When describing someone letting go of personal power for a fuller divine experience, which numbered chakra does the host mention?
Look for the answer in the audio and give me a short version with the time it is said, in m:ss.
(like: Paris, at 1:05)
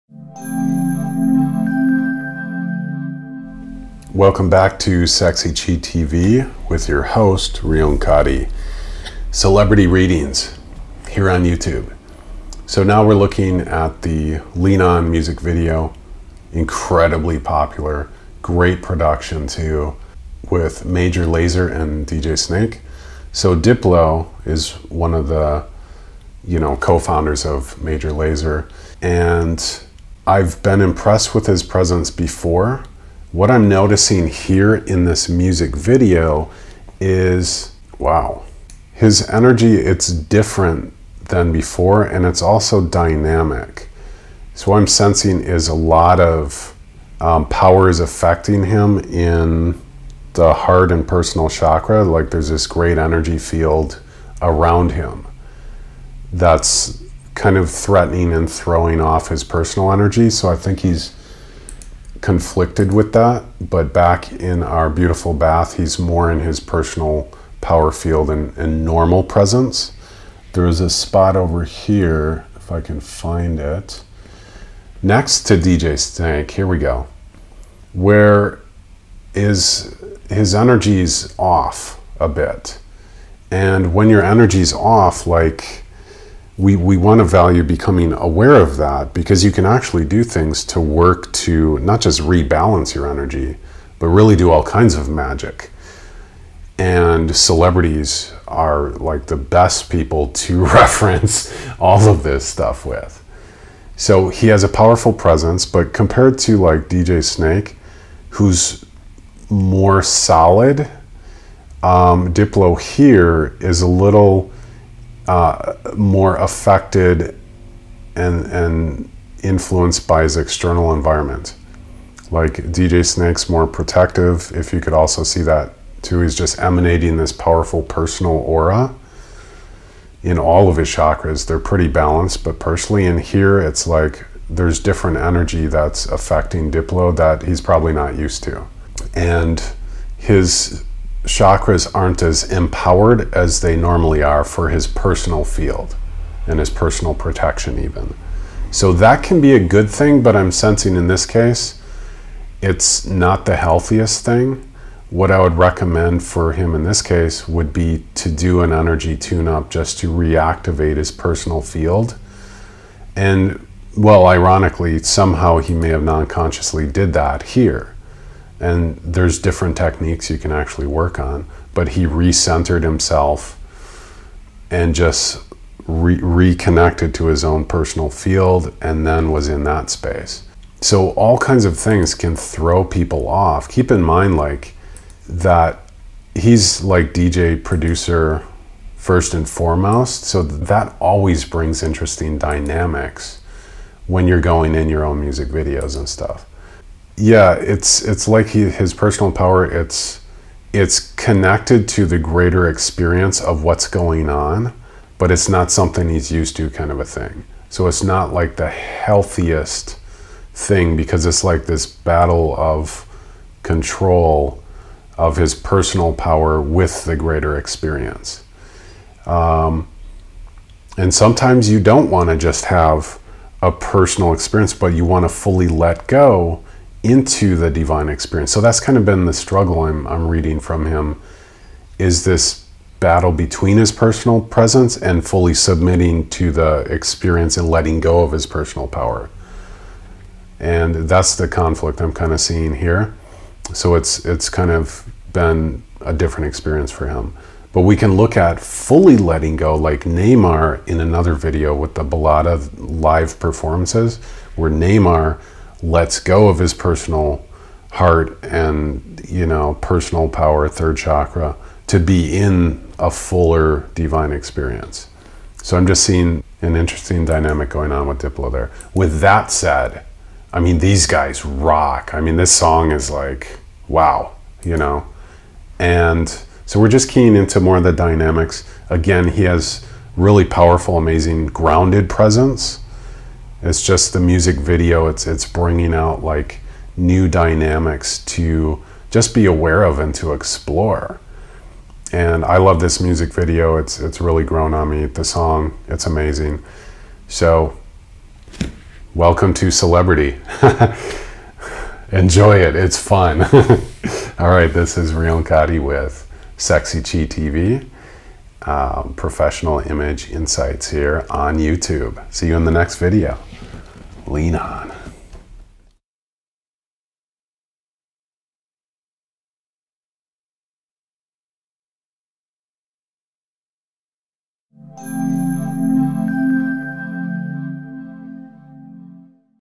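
Third chakra, at 4:20.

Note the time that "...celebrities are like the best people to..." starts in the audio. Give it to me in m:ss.
1:37.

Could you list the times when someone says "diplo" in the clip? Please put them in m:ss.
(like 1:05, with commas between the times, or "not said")
0:23, 1:52, 2:16, 4:28.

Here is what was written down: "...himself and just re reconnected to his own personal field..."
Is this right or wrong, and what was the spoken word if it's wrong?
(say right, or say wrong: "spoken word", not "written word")
right.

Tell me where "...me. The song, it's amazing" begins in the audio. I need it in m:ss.
4:54.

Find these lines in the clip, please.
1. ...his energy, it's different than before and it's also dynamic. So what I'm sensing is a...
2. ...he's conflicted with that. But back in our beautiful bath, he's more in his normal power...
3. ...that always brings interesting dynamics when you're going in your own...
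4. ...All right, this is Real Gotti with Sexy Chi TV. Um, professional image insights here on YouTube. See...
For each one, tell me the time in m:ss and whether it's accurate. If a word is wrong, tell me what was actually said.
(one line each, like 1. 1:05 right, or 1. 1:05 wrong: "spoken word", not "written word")
1. 0:38 right
2. 1:00 wrong: "personal", not "normal"
3. 3:10 right
4. 5:04 right.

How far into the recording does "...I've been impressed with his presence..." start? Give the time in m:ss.
0:30.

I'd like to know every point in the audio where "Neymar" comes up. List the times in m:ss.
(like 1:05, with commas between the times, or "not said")
4:10, 4:14.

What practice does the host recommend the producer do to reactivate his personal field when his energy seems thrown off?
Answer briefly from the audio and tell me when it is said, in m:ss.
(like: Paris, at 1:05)
Energy tune up, at 2:38.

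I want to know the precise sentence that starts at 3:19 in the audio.
It's it's connected to the greater experience of what's going on, but it's not something he's used to, kind of a thing.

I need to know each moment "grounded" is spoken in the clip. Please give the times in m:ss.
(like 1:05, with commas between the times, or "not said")
4:41.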